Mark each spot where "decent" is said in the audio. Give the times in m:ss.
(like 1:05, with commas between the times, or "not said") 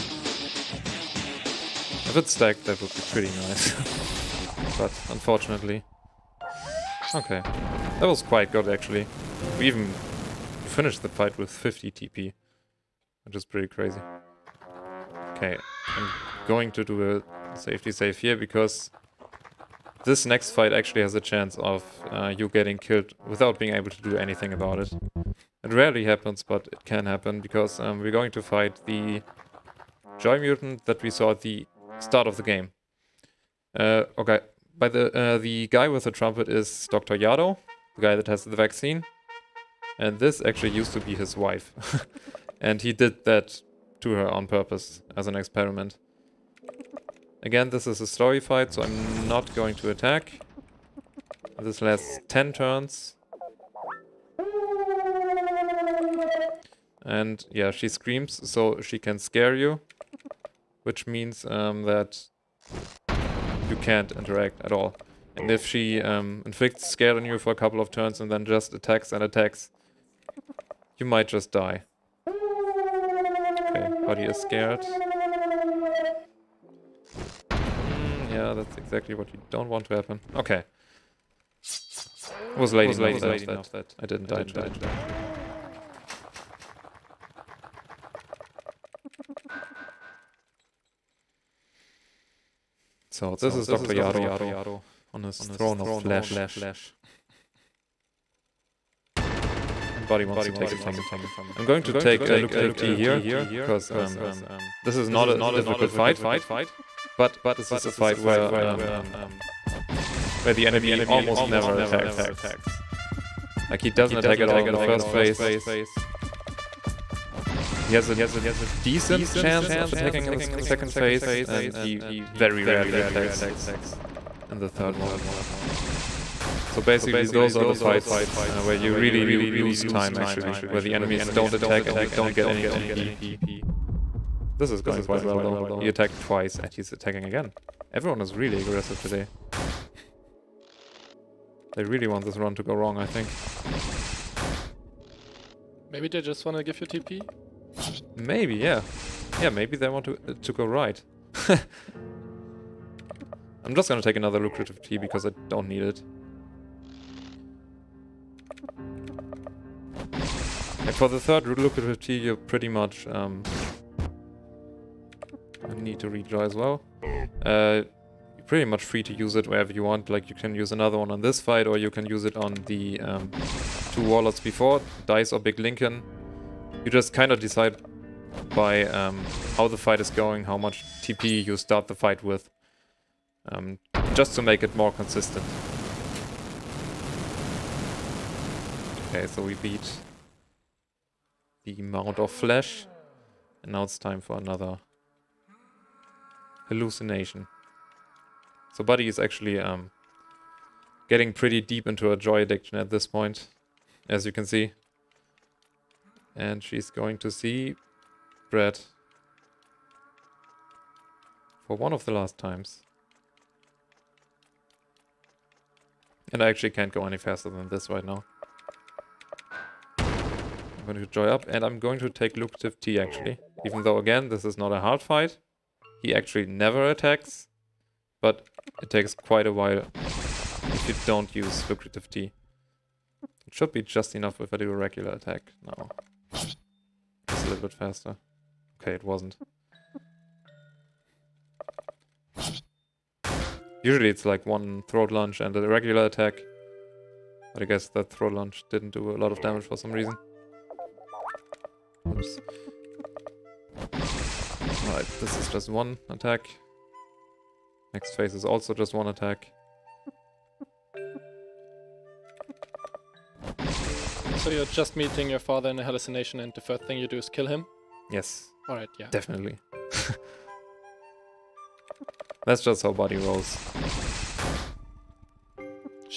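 1:58.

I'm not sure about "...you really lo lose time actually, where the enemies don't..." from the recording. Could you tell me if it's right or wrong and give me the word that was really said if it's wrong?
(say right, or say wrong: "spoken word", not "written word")
right.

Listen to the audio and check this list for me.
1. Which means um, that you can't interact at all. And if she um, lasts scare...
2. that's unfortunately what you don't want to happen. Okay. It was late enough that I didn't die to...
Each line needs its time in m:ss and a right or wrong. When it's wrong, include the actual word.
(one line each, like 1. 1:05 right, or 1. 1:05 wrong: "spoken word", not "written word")
1. 1:00 wrong: "inflicts", not "lasts"
2. 1:18 wrong: "exactly", not "unfortunately".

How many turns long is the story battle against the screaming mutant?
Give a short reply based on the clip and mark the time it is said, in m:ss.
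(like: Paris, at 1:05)
10, at 0:52.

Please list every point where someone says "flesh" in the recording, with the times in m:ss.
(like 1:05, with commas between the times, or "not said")
1:35, 3:12.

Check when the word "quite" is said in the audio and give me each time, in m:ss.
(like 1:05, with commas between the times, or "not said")
0:08, 2:15, 3:49.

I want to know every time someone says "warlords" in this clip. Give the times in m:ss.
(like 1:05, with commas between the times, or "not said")
2:54.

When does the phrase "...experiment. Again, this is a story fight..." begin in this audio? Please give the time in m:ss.
0:45.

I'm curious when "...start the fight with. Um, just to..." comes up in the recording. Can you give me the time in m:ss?
3:01.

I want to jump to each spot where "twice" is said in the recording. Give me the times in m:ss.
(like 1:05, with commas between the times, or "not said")
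2:16.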